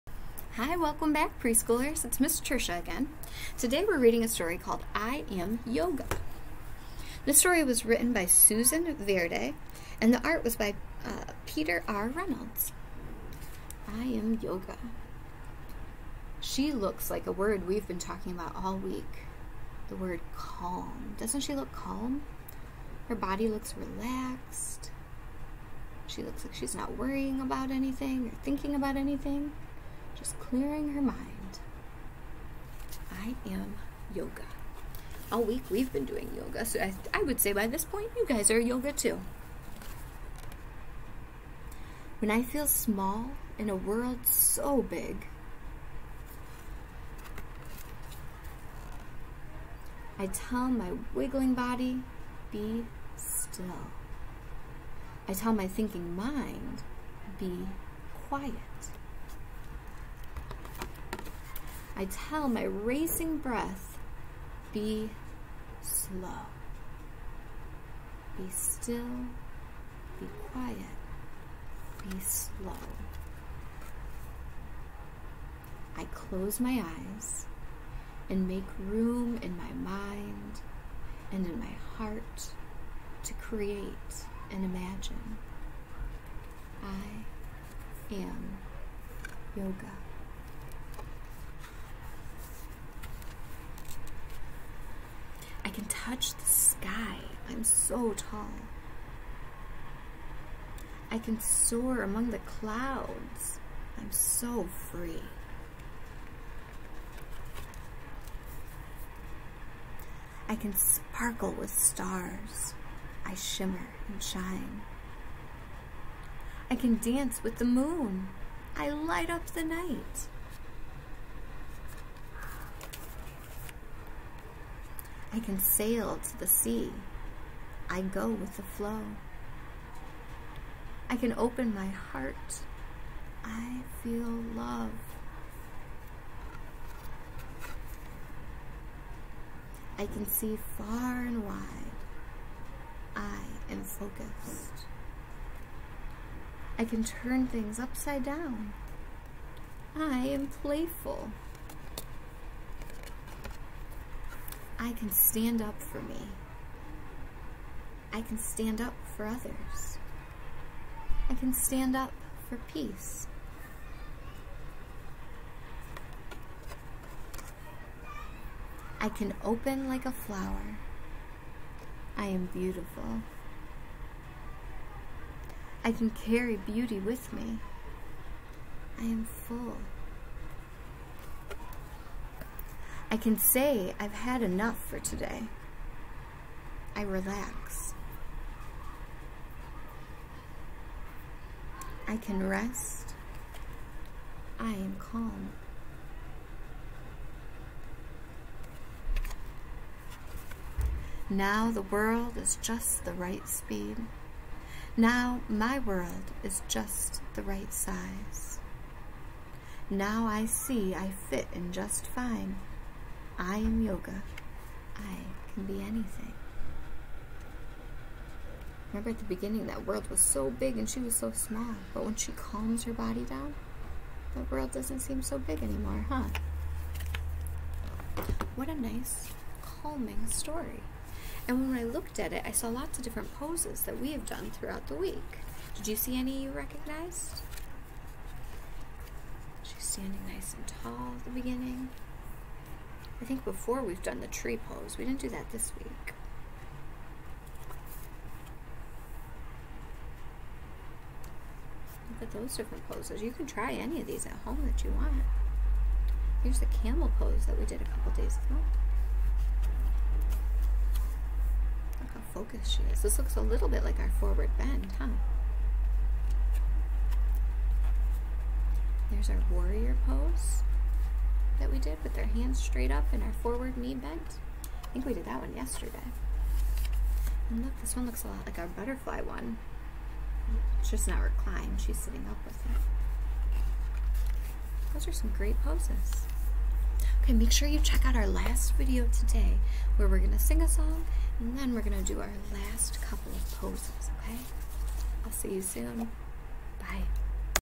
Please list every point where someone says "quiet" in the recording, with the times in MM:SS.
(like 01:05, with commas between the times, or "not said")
00:58, 01:10.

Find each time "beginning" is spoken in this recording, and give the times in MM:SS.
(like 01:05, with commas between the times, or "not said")
03:39, 04:01.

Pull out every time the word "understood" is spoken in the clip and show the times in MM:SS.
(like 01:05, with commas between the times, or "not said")
not said.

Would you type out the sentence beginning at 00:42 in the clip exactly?
When I feel small in a world so big, I tell my wiggling body, be still.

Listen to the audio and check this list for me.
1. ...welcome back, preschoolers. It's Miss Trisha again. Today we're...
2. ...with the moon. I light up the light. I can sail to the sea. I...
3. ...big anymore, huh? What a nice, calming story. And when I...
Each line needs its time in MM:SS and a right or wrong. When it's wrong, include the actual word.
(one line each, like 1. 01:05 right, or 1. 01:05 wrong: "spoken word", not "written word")
1. 00:00 right
2. 01:57 wrong: "night", not "light"
3. 03:45 right.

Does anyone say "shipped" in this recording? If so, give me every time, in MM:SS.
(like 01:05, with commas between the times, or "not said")
not said.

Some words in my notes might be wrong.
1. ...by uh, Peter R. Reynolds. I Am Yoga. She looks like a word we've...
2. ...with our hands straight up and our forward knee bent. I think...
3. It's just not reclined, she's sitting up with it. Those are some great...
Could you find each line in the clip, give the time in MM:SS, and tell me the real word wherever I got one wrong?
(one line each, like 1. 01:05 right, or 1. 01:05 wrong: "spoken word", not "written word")
1. 00:10 right
2. 04:32 right
3. 04:40 right.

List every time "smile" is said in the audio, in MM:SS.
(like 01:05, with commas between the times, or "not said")
not said.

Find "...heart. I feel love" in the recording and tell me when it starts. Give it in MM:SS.
02:11.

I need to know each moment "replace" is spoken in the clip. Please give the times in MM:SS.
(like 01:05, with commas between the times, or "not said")
not said.